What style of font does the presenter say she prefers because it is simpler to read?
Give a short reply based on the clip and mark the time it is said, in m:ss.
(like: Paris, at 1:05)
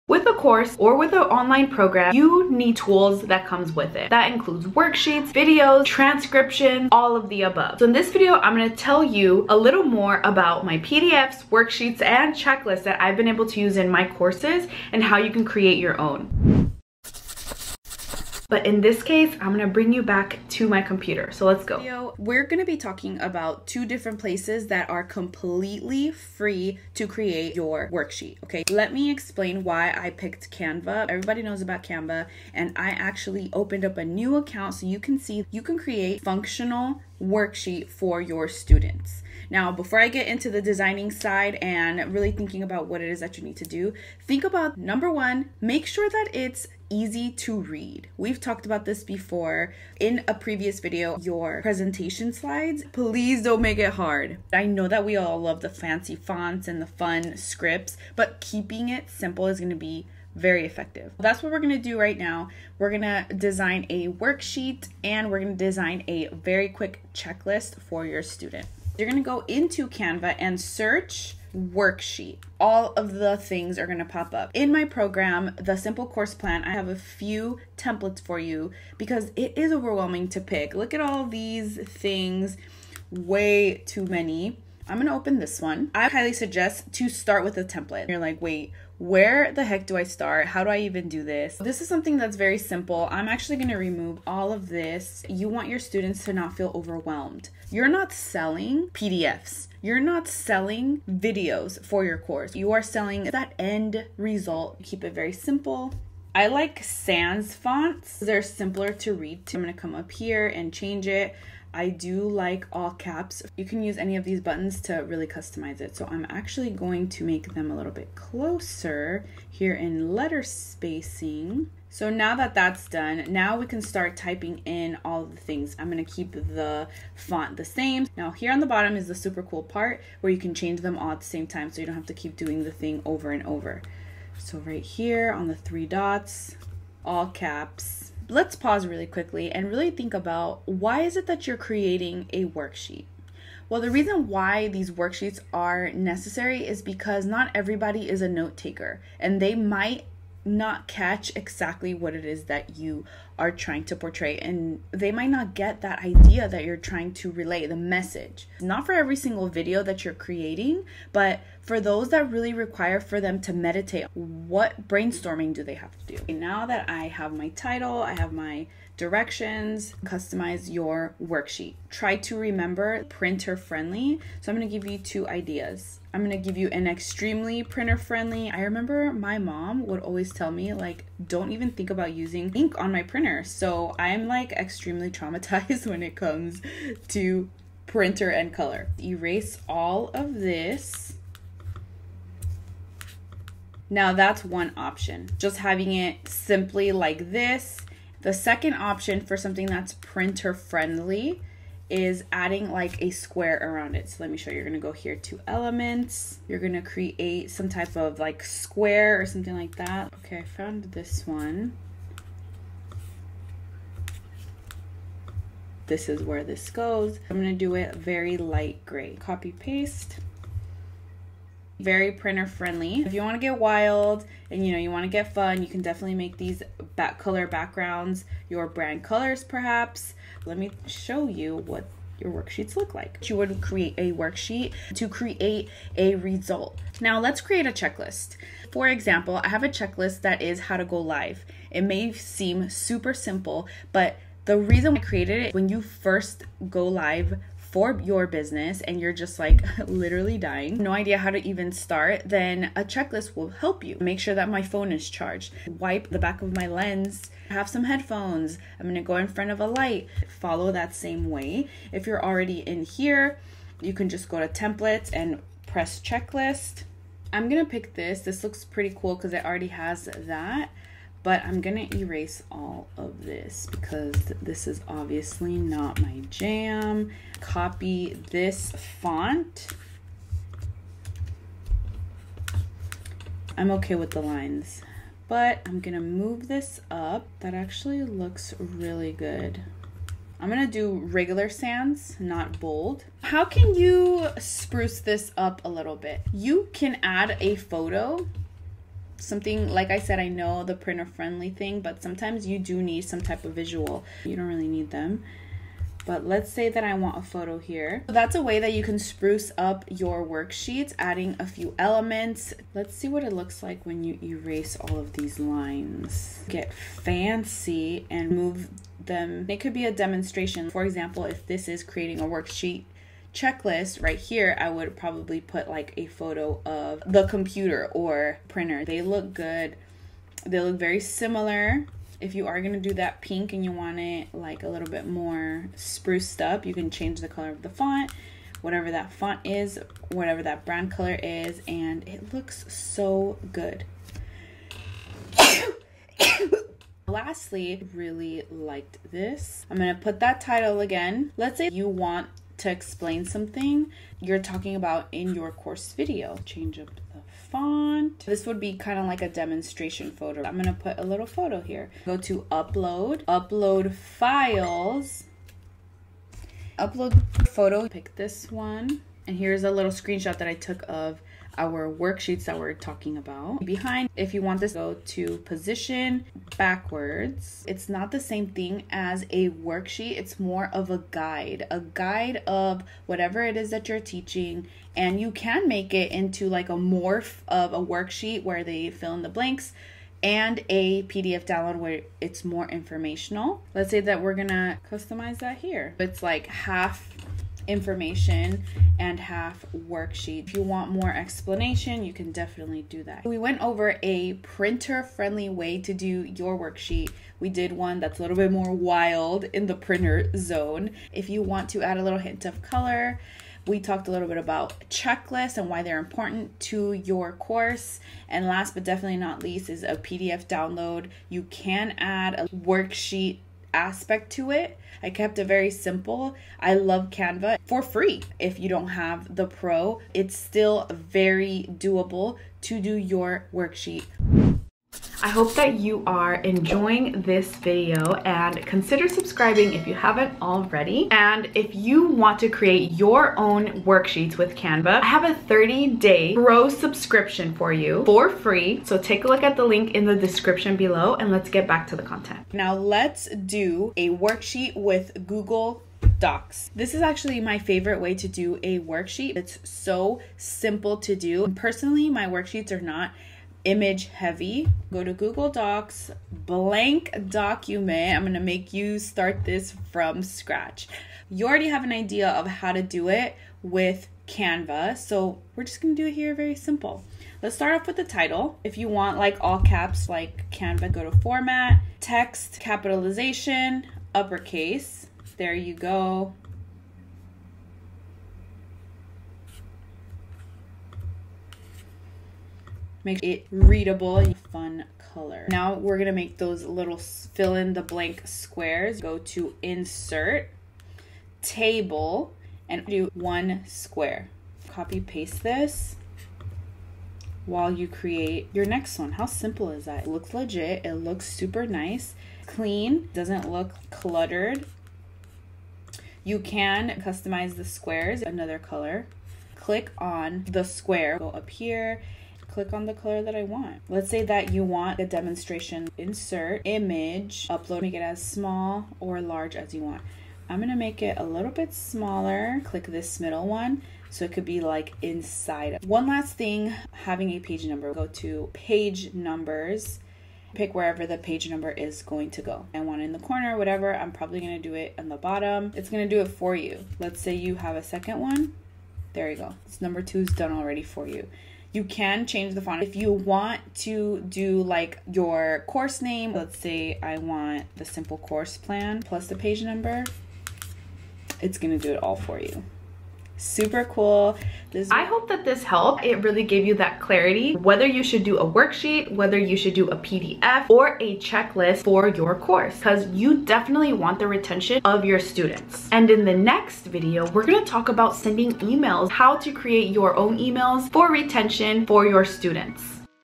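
Sans fonts, at 1:46.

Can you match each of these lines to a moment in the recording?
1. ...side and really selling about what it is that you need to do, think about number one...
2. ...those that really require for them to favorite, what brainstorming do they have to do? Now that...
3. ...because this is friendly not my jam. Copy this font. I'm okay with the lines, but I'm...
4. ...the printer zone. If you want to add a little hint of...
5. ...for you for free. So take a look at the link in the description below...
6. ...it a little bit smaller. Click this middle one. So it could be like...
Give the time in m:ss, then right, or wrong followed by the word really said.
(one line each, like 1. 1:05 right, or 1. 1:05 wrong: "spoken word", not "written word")
1. 0:41 wrong: "thinking", not "selling"
2. 2:41 wrong: "meditate", not "favorite"
3. 4:33 wrong: "obviously", not "friendly"
4. 6:49 right
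5. 7:27 right
6. 8:51 right.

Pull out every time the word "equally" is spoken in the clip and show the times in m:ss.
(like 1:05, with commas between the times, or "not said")
not said.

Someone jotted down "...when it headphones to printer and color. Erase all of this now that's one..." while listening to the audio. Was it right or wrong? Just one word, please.
wrong.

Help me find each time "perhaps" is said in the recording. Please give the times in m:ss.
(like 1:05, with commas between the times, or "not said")
3:49.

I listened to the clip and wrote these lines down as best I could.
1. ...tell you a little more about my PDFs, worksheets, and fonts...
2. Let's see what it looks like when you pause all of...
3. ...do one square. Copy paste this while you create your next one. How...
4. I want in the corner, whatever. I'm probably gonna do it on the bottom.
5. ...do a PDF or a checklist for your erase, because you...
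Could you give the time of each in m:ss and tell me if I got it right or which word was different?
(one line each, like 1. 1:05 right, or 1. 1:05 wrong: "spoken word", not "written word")
1. 0:08 wrong: "checklists", not "fonts"
2. 5:12 wrong: "erase", not "pause"
3. 8:22 right
4. 9:02 right
5. 9:29 wrong: "course", not "erase".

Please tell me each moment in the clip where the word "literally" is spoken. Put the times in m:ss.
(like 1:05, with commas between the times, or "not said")
4:09.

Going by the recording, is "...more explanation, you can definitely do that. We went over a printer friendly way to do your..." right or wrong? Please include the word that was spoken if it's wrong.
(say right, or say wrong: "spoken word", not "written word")
right.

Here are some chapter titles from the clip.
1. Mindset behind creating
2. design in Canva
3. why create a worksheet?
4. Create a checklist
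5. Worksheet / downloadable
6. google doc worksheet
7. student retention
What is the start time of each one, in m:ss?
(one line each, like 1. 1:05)
1. 0:28
2. 1:09
3. 2:20
4. 3:38
5. 5:47
6. 7:32
7. 9:25.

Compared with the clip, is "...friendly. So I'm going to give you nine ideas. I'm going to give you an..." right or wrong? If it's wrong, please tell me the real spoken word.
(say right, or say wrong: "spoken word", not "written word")
wrong: "two", not "nine".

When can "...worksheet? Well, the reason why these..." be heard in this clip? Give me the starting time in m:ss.
2:22.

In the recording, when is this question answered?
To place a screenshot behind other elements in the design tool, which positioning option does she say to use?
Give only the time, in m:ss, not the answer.
6:15.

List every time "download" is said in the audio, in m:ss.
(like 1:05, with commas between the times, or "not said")
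6:31, 7:00.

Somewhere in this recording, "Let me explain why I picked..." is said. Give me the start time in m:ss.
0:28.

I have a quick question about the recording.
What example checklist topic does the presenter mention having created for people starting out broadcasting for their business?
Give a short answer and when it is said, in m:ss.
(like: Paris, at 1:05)
How to go live, at 4:00.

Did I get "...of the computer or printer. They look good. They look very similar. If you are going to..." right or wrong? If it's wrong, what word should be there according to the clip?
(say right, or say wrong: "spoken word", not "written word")
right.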